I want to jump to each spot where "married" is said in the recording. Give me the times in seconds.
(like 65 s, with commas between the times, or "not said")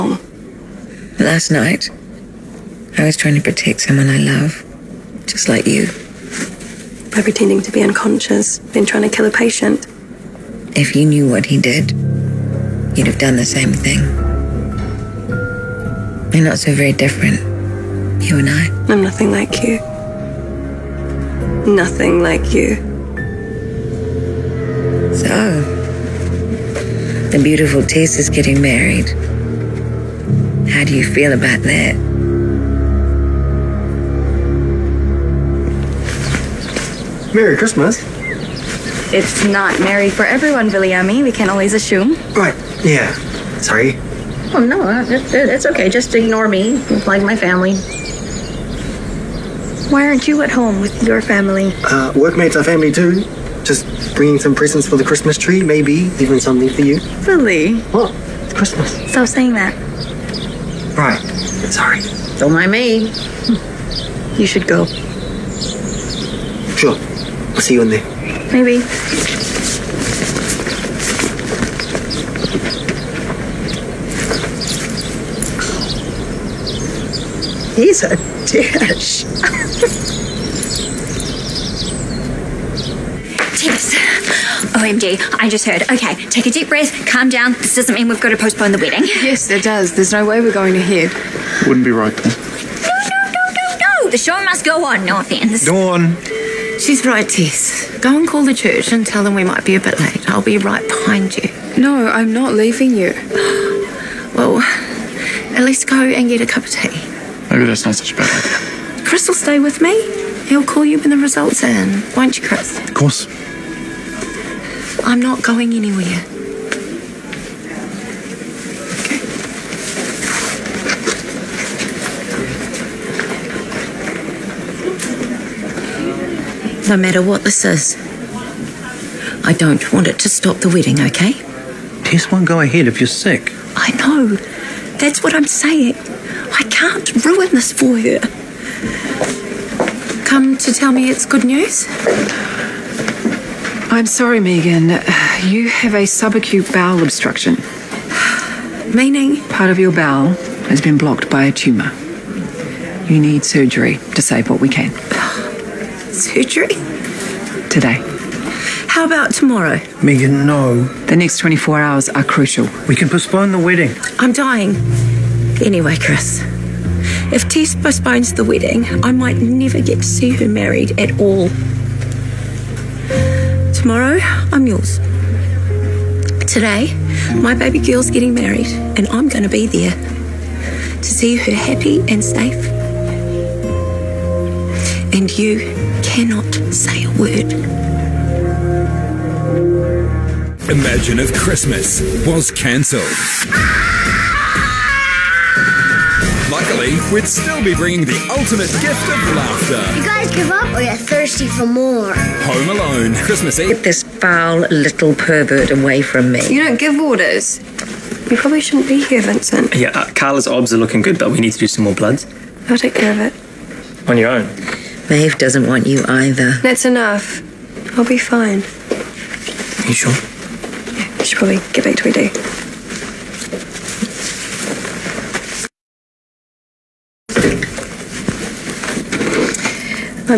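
28 s, 170 s, 178 s.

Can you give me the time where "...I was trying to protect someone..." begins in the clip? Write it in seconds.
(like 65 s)
2 s.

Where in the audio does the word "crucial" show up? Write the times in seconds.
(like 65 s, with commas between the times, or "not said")
162 s.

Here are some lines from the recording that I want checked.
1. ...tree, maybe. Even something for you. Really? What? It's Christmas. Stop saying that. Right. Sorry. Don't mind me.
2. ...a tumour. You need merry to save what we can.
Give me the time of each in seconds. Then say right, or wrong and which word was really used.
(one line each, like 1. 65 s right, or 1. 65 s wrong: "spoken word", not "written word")
1. 55 s right
2. 151 s wrong: "surgery", not "merry".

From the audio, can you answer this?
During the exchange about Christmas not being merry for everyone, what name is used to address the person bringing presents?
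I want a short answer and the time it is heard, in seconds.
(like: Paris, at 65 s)
Viliami, at 40 s.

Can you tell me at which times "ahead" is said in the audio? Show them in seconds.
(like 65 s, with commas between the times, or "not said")
90 s, 132 s.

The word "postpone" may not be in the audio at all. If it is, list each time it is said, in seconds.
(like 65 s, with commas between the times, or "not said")
88 s, 163 s, 167 s.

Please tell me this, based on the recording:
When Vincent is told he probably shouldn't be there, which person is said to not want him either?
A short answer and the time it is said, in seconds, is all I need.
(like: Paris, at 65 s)
Maeve, at 215 s.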